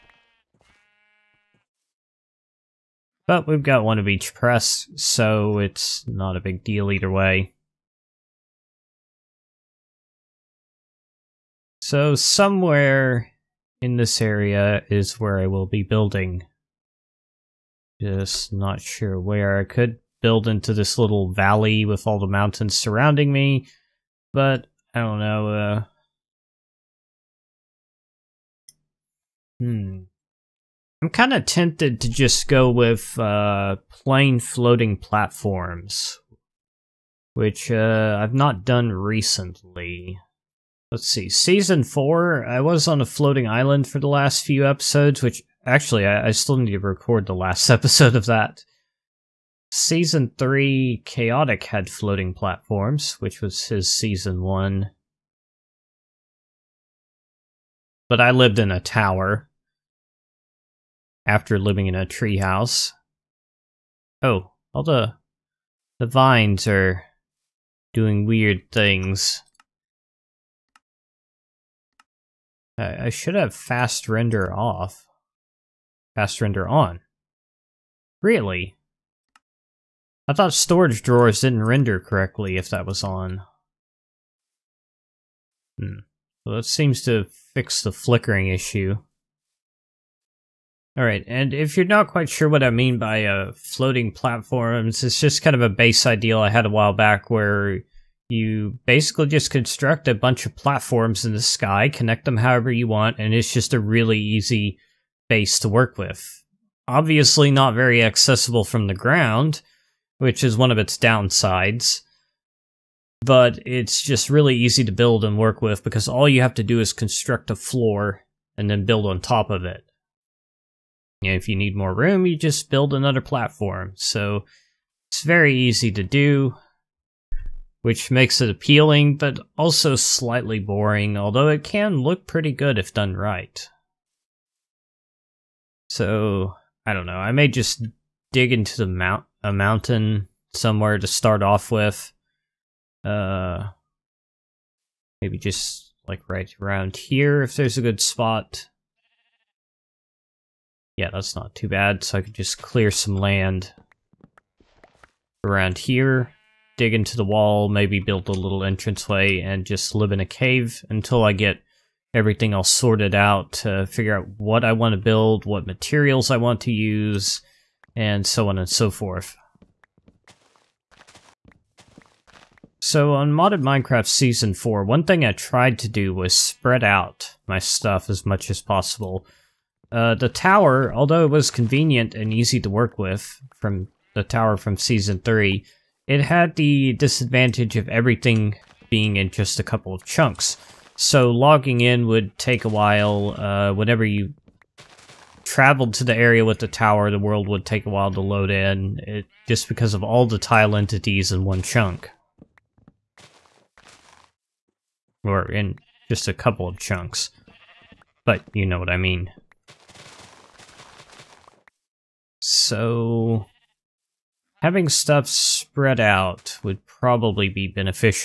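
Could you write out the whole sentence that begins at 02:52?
So on Modded Minecraft Season 4, one thing I tried to do was spread out my stuff as much as possible.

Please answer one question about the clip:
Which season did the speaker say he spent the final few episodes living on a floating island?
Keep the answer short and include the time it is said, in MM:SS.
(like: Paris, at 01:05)
Season 4, at 00:41.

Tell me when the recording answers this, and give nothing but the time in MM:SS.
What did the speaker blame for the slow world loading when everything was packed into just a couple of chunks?
03:20.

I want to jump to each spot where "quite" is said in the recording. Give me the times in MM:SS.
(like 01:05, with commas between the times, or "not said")
01:32.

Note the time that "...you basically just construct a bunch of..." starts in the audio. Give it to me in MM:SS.
01:38.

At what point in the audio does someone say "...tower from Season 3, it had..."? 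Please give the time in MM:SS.
03:04.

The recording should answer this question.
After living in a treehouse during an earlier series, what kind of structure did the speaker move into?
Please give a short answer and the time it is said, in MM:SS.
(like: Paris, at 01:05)
a tower, at 00:58.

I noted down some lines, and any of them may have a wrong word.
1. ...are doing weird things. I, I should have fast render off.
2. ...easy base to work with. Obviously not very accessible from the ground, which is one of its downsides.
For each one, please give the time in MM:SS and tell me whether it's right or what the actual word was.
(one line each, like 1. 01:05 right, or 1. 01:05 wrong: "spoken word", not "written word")
1. 01:06 right
2. 01:44 right.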